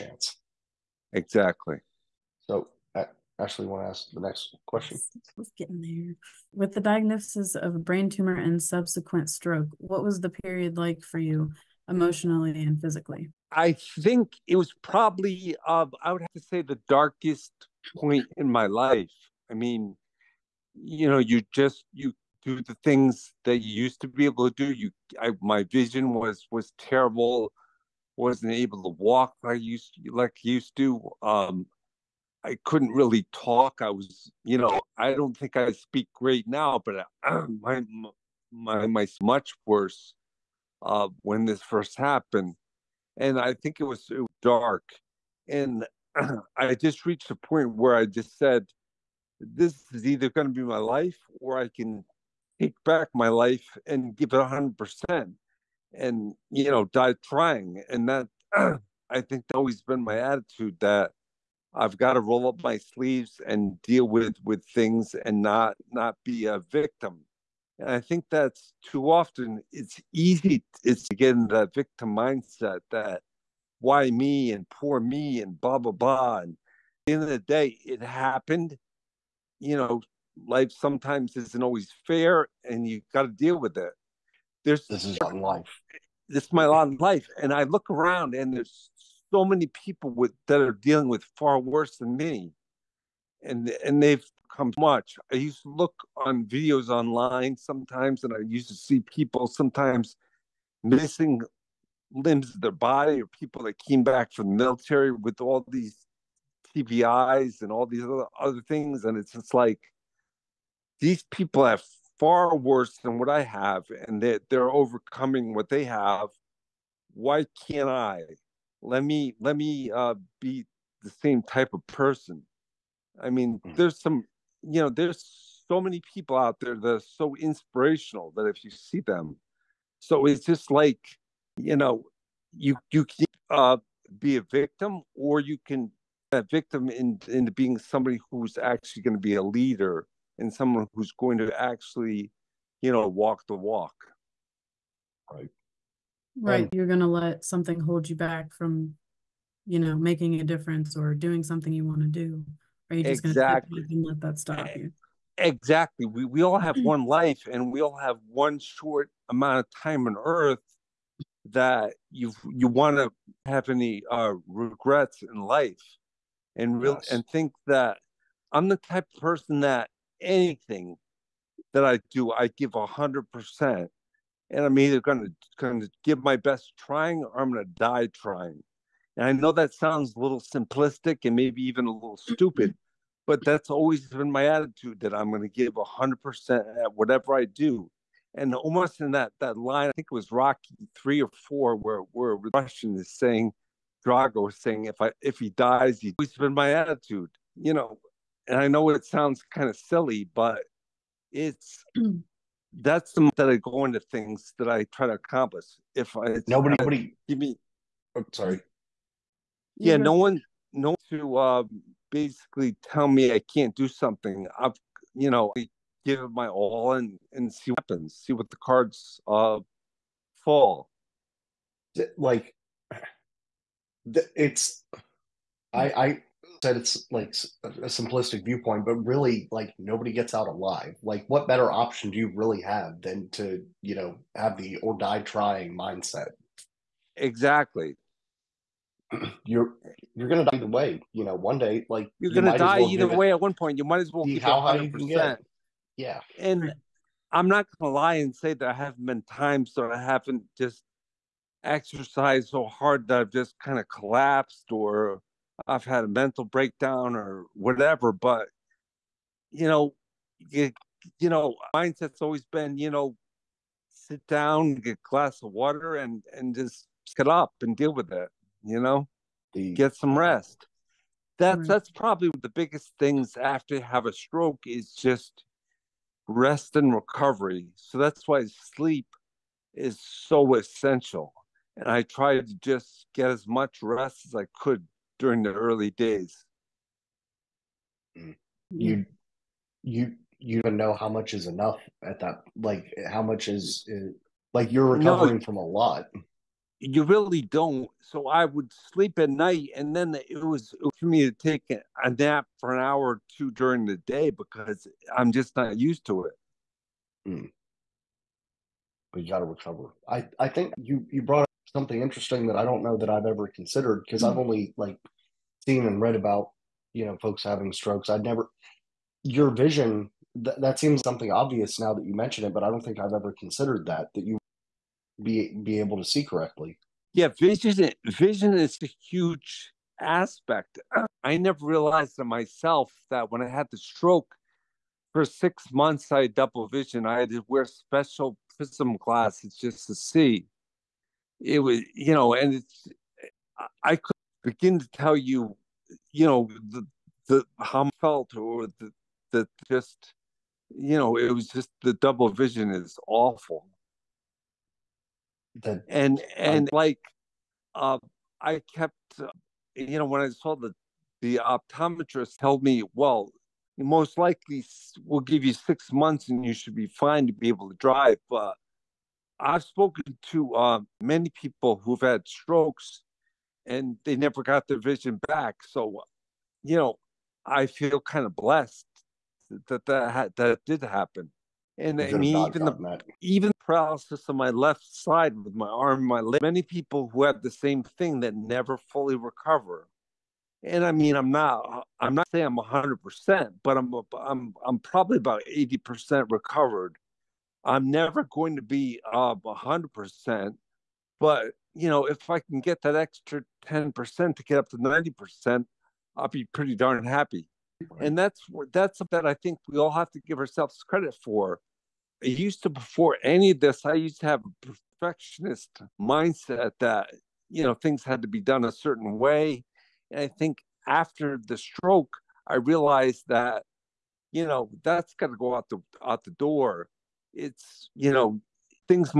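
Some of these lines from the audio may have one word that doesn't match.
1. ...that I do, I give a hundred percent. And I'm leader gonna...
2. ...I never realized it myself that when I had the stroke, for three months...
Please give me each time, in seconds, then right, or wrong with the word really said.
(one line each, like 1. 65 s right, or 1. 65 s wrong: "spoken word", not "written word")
1. 171 s wrong: "either", not "leader"
2. 331 s wrong: "six", not "three".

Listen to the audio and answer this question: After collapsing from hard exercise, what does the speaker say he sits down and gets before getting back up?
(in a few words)
a glass of water.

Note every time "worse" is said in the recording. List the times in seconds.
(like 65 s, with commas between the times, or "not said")
39 s, 91 s, 112 s.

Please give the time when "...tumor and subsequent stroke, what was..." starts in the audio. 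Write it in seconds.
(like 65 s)
8 s.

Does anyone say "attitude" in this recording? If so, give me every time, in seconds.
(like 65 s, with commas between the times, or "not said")
60 s, 184 s, 196 s.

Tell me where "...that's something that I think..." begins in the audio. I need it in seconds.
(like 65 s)
408 s.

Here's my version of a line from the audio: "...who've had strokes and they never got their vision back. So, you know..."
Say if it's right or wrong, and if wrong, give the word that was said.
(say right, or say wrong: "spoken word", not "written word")
right.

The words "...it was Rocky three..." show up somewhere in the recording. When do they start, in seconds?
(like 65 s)
190 s.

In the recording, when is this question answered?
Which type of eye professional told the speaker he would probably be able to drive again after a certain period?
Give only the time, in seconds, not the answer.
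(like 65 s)
361 s.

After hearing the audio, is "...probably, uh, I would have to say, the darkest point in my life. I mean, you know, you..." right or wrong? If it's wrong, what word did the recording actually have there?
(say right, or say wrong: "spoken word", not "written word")
right.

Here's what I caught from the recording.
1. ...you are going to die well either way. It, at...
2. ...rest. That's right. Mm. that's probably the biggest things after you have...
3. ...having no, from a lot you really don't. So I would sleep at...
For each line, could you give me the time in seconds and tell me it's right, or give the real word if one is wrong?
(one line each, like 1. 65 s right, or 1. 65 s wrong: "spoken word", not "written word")
1. 242 s right
2. 270 s right
3. 294 s wrong: "recovering", not "having".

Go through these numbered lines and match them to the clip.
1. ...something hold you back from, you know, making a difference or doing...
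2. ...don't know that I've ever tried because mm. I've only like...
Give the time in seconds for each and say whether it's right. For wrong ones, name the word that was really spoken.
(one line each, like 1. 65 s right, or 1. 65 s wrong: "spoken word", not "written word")
1. 147 s right
2. 312 s wrong: "considered", not "tried".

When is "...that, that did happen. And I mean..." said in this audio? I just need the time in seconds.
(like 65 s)
379 s.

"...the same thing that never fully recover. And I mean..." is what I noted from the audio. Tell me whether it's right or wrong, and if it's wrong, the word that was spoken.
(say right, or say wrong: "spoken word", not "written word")
right.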